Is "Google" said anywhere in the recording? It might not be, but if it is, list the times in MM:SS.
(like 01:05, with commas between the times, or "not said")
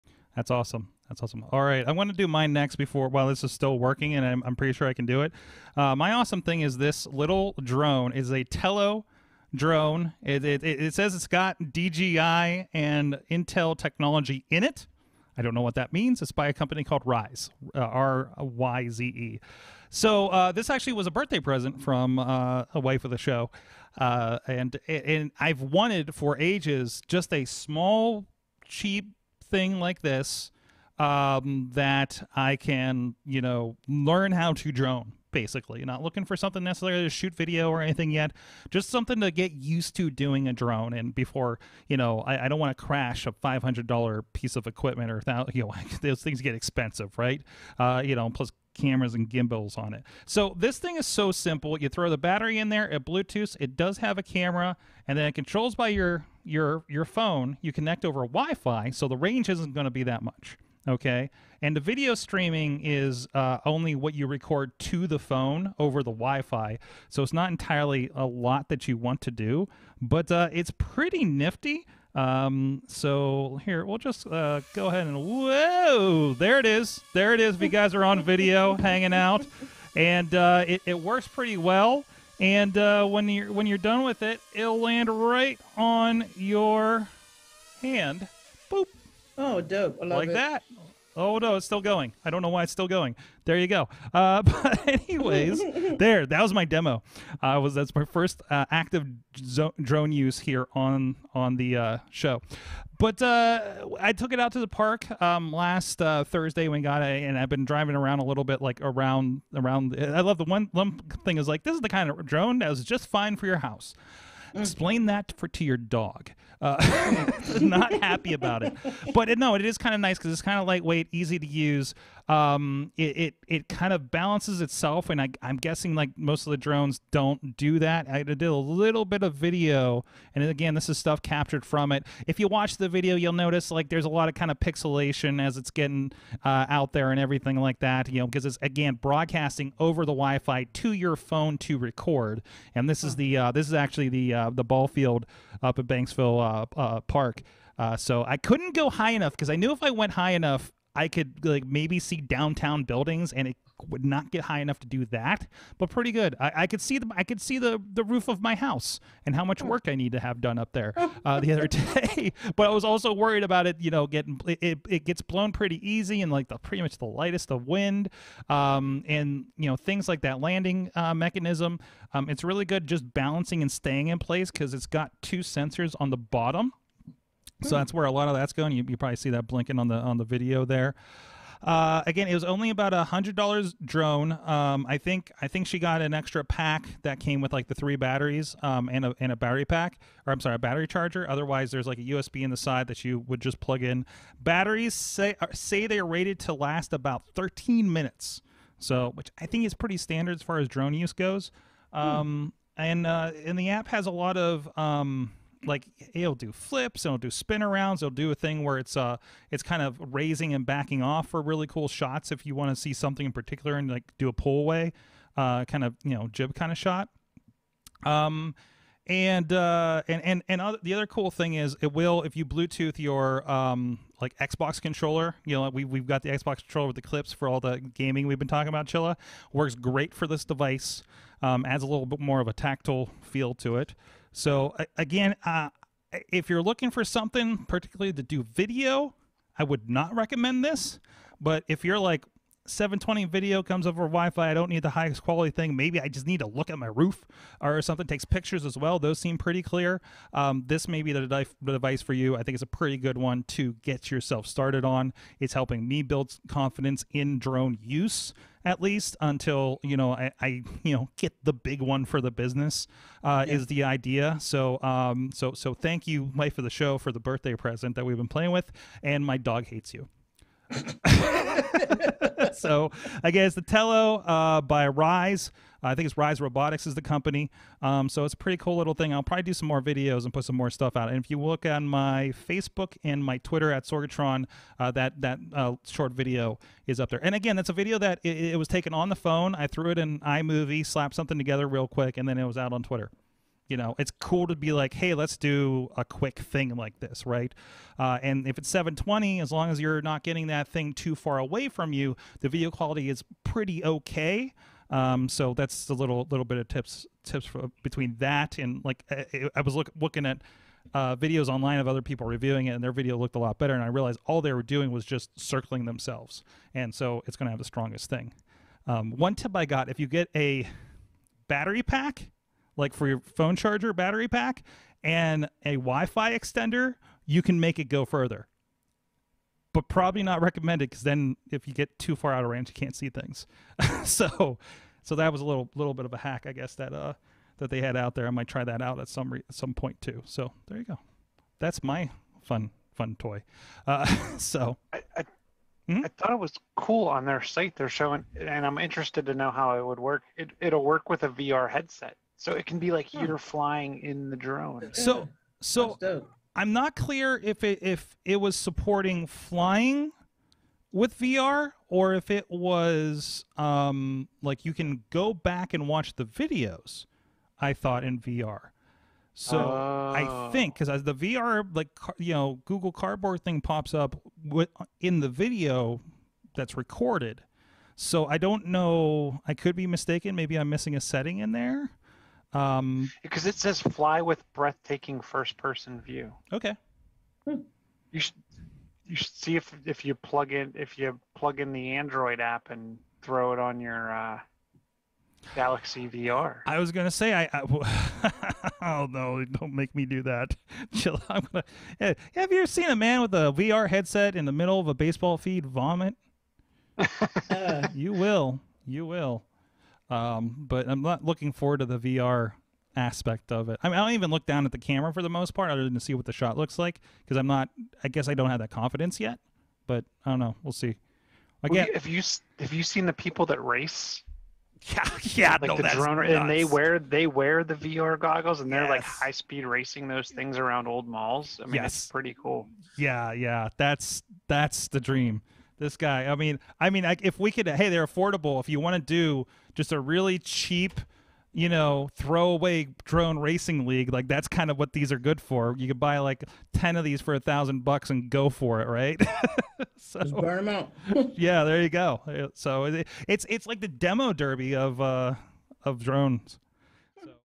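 06:12.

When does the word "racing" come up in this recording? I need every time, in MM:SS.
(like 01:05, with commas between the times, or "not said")
07:09, 07:23.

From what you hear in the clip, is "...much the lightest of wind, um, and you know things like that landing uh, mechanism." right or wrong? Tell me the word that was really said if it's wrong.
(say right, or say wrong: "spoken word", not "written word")
right.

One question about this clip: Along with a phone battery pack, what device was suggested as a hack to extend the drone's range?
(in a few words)
Wi-Fi extender.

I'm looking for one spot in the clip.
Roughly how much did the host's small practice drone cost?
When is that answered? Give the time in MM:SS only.
03:02.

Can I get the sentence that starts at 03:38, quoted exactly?
Um, and uh, and and and other, the other cool thing is it will if you Bluetooth your um, like Xbox controller.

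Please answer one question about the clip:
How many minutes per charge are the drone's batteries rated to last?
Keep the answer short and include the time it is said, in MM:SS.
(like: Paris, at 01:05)
13 minutes, at 03:17.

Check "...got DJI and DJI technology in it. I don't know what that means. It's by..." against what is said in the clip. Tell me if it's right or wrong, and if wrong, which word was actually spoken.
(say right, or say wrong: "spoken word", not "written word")
wrong: "Intel", not "DJI".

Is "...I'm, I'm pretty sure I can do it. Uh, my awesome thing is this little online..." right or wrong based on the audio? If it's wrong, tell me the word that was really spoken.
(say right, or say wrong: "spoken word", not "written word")
wrong: "drone", not "online".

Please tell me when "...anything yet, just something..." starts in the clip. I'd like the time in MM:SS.
00:37.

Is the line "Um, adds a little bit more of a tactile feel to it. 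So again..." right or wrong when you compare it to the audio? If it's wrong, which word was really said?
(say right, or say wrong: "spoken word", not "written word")
right.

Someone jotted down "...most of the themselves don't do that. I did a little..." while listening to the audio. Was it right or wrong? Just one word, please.
wrong.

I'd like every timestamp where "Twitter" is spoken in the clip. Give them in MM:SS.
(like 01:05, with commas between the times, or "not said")
04:43, 04:52.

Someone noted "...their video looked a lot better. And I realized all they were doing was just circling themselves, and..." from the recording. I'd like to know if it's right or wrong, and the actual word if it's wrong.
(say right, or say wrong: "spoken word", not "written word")
right.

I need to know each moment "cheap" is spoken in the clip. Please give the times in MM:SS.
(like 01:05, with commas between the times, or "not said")
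00:28, 07:20.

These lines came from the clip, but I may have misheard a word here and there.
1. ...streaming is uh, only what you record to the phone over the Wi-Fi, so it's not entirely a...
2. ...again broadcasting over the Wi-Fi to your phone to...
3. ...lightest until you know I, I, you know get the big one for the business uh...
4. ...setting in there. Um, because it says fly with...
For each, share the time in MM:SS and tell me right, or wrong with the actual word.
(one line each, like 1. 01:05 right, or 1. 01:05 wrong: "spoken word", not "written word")
1. 01:02 right
2. 02:18 right
3. 04:18 wrong: "least", not "lightest"
4. 06:21 right.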